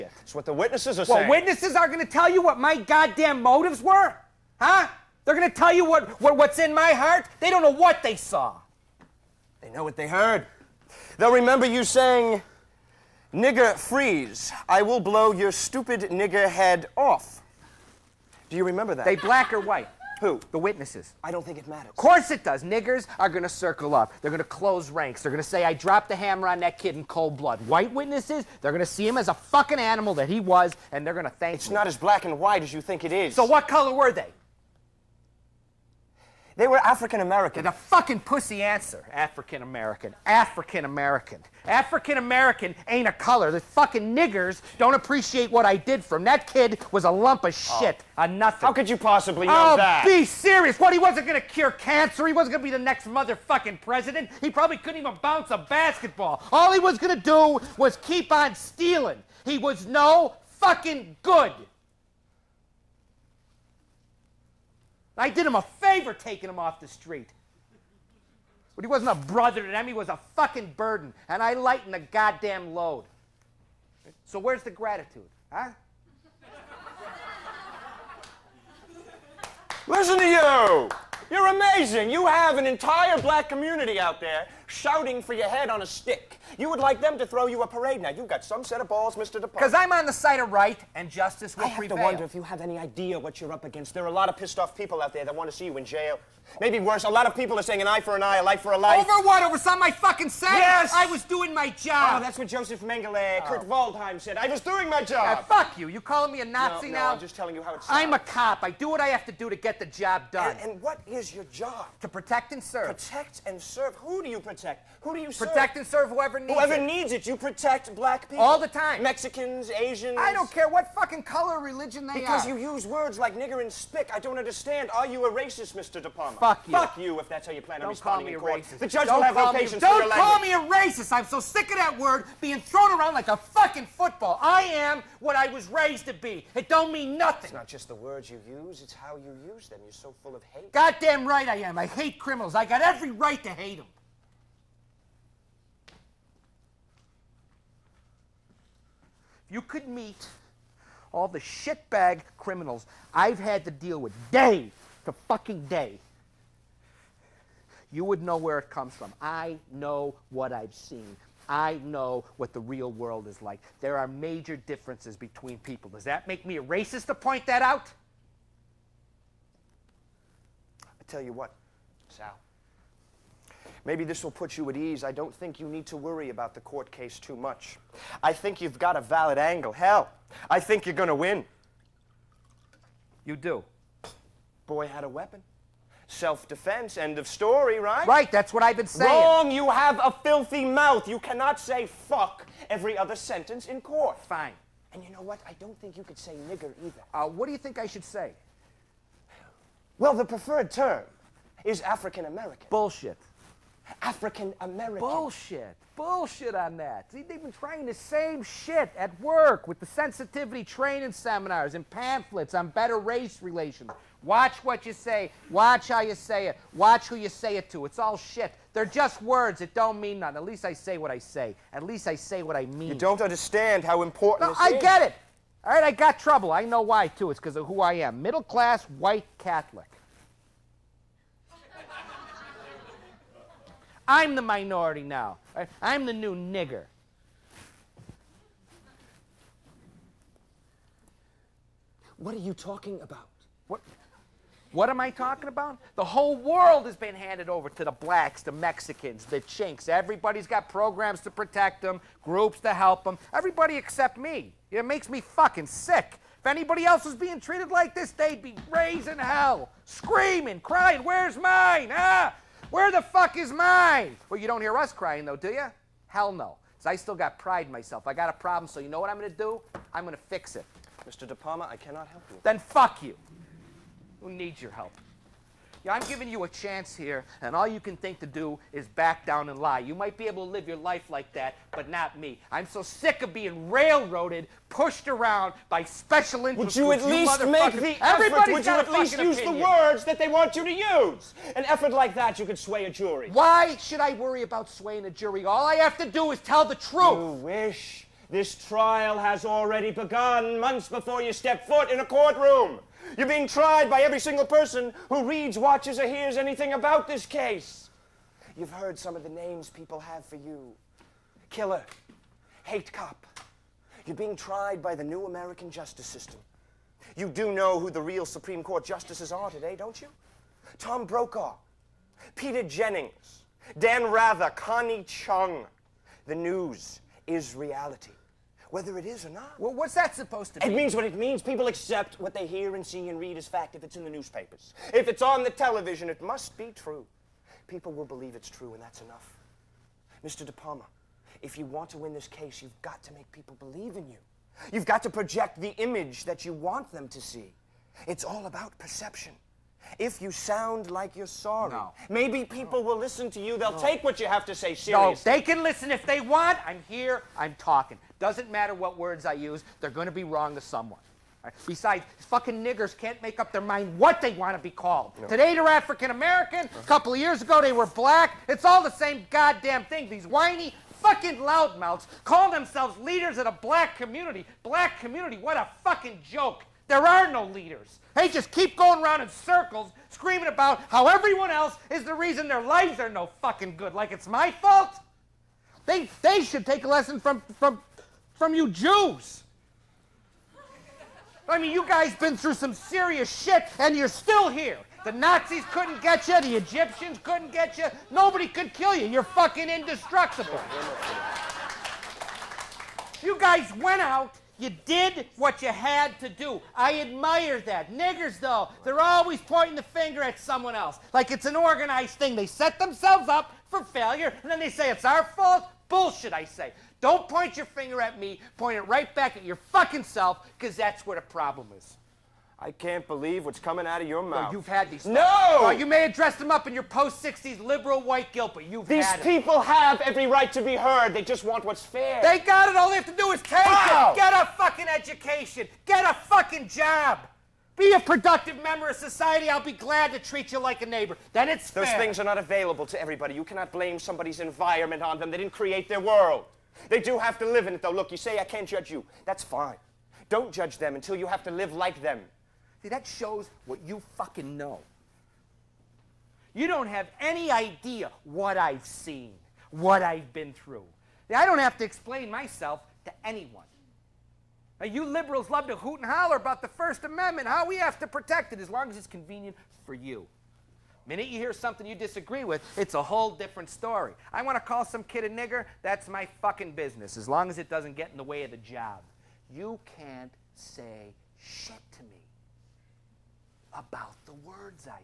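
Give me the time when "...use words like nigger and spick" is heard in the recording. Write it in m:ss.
2:02.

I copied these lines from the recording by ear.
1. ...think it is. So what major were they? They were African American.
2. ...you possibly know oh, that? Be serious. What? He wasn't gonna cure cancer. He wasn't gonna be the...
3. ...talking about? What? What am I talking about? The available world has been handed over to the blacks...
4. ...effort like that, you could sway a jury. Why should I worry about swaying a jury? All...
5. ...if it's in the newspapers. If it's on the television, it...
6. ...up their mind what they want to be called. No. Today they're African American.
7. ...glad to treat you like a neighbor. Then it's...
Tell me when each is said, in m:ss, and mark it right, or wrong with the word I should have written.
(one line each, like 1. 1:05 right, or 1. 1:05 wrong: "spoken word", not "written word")
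1. 0:32 wrong: "color", not "major"
2. 0:48 right
3. 4:02 wrong: "whole", not "available"
4. 4:51 right
5. 5:33 right
6. 6:03 right
7. 7:19 right.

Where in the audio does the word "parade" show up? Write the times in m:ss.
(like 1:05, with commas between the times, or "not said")
1:27.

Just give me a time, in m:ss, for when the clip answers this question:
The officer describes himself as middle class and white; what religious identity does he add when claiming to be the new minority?
3:49.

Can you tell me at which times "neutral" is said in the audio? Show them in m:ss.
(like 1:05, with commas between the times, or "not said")
not said.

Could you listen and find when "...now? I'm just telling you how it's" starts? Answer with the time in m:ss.
1:46.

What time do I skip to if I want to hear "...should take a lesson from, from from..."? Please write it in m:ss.
6:26.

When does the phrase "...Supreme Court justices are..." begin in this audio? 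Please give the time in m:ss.
5:18.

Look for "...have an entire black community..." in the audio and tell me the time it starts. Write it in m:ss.
1:22.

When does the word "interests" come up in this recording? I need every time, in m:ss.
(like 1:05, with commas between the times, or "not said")
4:46.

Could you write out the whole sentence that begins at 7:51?
The minute you hear something you disagree with, it's a whole different story.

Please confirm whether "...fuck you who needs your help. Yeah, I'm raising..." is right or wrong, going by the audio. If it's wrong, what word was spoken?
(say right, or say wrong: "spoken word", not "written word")
wrong: "giving", not "raising".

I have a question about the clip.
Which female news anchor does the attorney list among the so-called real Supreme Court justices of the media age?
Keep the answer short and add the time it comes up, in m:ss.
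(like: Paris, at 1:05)
Connie Chung, at 5:24.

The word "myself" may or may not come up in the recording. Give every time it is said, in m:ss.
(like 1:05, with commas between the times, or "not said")
4:27, 7:42.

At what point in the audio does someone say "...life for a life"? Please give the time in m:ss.
1:38.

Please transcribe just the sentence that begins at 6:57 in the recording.
Don't point your finger at me.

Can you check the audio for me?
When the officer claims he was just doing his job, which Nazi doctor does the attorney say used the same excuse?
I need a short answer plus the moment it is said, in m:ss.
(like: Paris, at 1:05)
Joseph Mengele, at 1:42.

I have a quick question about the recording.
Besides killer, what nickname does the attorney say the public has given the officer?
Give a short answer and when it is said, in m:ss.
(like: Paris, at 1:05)
Hate cop, at 5:12.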